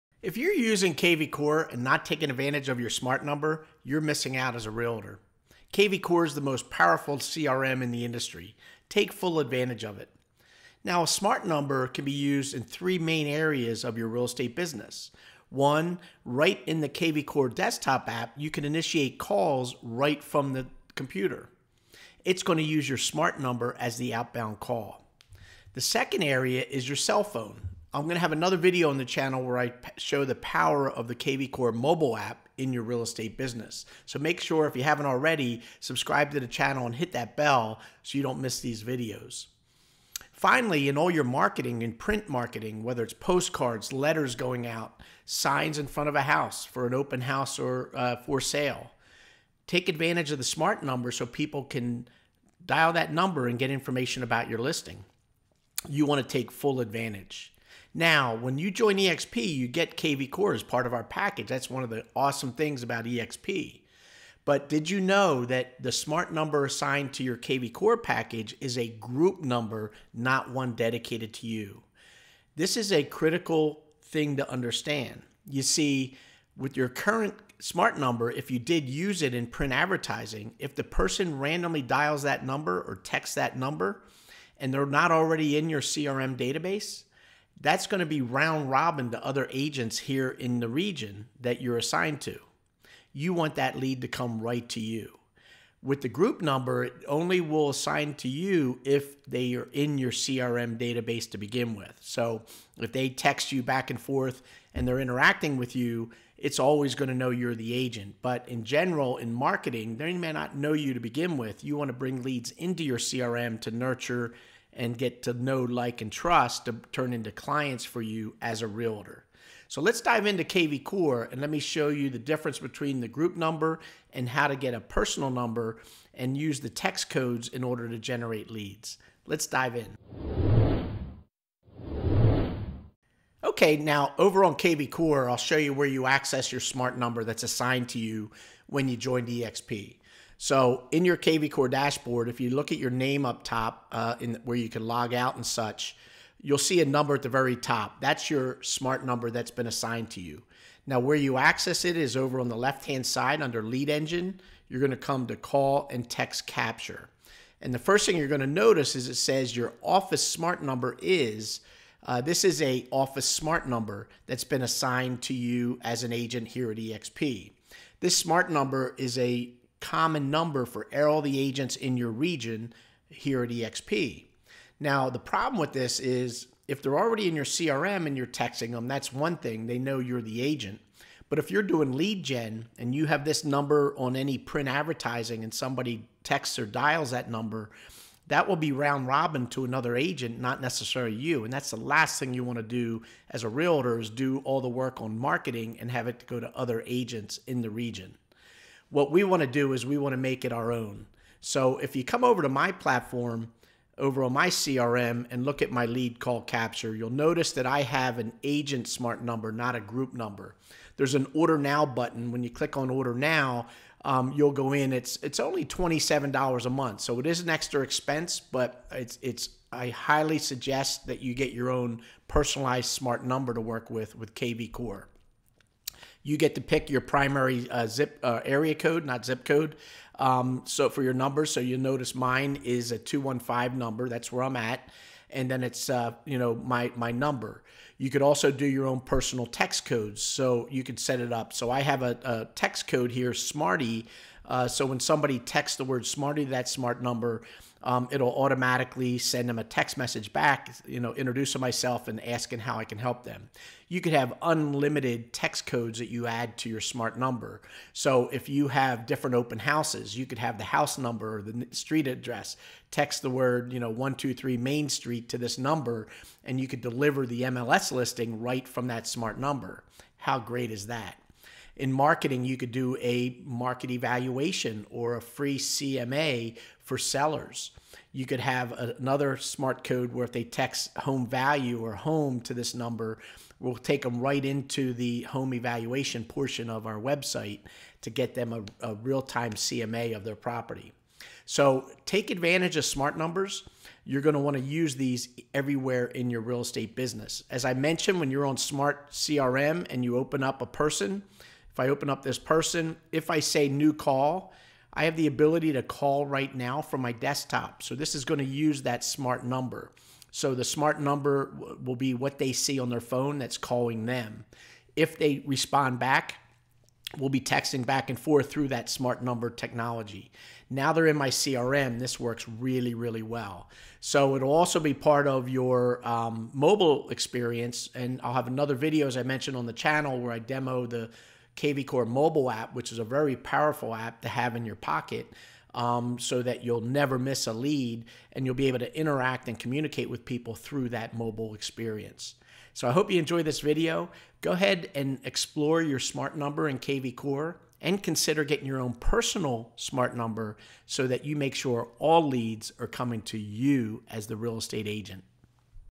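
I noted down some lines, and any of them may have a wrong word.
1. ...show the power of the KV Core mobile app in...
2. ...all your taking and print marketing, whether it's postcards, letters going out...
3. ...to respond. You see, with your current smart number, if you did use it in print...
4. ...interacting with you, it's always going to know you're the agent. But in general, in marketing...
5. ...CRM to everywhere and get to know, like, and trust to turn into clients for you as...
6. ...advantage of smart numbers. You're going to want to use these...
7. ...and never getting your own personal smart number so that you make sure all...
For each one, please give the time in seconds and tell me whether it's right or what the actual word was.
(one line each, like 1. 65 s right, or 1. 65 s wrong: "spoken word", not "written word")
1. 29 s right
2. 40 s wrong: "marketing", not "taking"
3. 74 s wrong: "understand", not "respond"
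4. 104 s right
5. 112 s wrong: "nurture", not "everywhere"
6. 292 s right
7. 347 s wrong: "consider", not "never".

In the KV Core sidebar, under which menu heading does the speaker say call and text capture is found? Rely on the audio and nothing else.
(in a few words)
lead engine.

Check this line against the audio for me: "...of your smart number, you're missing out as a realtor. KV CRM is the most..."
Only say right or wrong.
wrong.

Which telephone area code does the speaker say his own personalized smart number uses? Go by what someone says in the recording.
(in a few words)
215.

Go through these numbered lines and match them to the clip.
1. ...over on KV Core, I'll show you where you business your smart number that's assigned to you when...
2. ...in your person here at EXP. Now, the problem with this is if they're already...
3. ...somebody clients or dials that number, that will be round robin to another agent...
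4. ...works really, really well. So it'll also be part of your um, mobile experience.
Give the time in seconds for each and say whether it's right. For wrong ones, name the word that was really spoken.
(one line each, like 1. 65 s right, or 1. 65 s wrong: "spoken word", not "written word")
1. 134 s wrong: "access", not "business"
2. 171 s wrong: "region", not "person"
3. 185 s wrong: "texts", not "clients"
4. 322 s right.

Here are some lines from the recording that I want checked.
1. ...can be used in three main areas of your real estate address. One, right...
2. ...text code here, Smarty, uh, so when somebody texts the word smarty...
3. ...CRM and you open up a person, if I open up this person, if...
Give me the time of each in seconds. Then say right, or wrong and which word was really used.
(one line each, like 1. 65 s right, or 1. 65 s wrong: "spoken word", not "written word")
1. 11 s wrong: "business", not "address"
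2. 242 s right
3. 299 s right.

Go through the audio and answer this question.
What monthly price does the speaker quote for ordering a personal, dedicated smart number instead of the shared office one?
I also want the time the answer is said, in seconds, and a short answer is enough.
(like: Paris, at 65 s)
$27, at 215 s.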